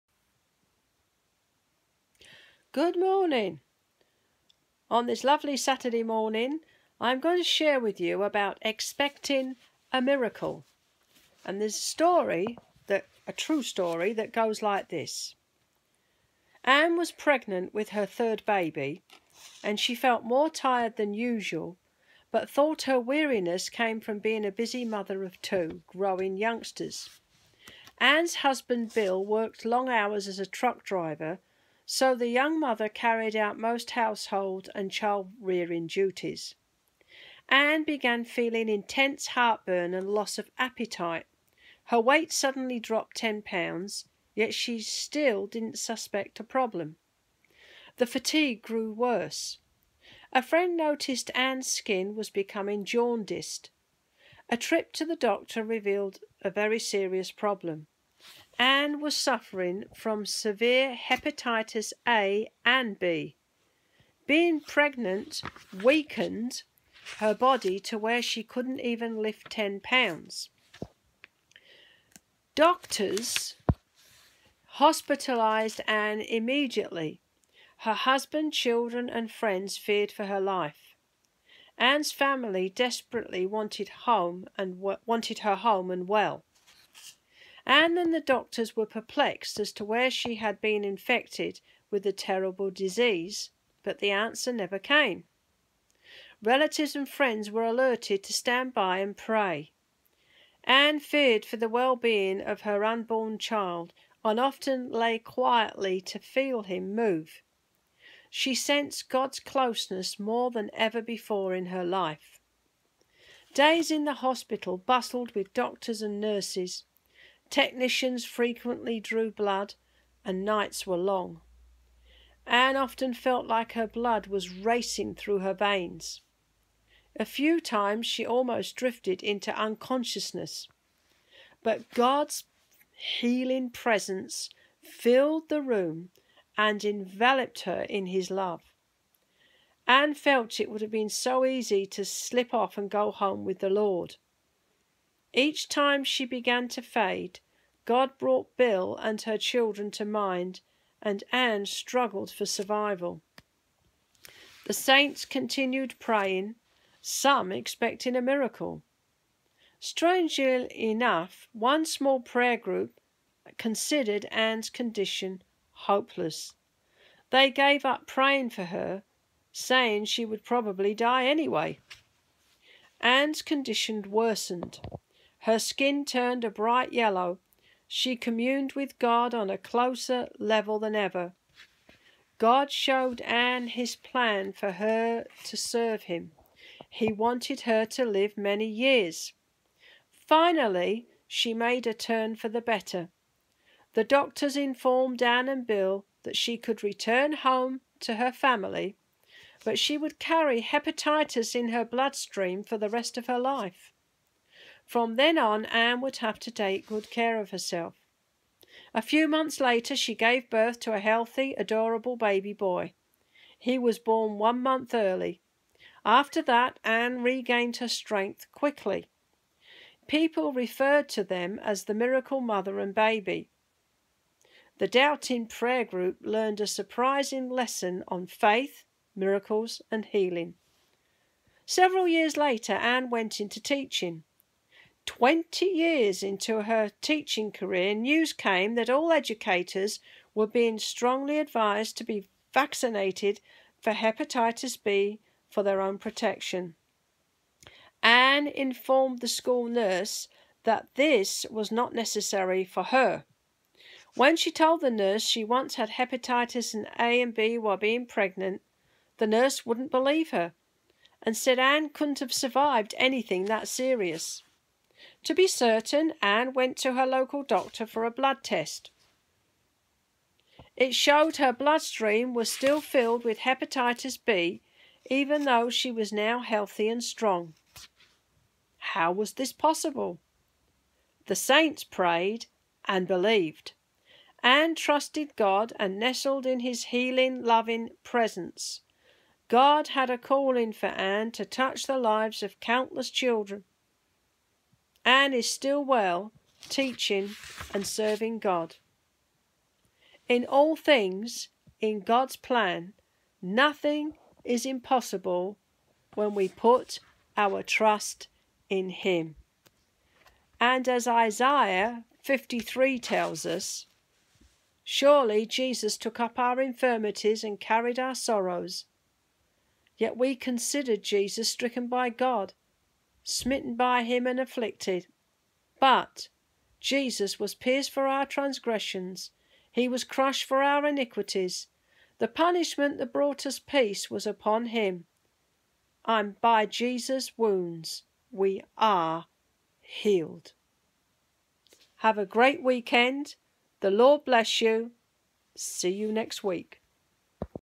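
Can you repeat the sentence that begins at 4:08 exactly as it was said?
Anne informed the school nurse that this was not necessary for her.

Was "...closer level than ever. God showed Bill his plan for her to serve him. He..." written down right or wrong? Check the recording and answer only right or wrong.
wrong.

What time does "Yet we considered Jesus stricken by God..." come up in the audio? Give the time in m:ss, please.
5:19.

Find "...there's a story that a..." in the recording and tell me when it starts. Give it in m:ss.
0:11.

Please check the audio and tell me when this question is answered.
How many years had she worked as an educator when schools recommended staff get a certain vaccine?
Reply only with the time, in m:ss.
3:55.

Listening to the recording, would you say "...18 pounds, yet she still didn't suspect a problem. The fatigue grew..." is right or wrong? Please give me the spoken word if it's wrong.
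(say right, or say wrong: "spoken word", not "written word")
wrong: "10", not "18".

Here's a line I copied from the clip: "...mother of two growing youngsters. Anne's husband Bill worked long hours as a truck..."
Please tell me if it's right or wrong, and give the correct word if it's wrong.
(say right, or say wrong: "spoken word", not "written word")
right.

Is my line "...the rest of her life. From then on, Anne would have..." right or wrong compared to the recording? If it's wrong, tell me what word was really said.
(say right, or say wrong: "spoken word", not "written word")
right.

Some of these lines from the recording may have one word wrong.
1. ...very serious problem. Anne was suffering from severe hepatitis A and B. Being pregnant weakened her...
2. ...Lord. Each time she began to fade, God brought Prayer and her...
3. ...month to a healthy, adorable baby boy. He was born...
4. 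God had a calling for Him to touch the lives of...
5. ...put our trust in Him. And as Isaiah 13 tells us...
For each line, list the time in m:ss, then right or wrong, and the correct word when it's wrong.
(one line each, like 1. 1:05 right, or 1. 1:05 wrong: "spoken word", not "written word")
1. 0:56 right
2. 2:23 wrong: "Bill", not "Prayer"
3. 3:30 wrong: "birth", not "month"
4. 4:49 wrong: "Anne", not "Him"
5. 5:06 wrong: "53", not "13".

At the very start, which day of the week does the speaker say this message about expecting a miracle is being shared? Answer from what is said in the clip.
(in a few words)
Saturday.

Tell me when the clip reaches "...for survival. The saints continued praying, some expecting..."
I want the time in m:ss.
2:32.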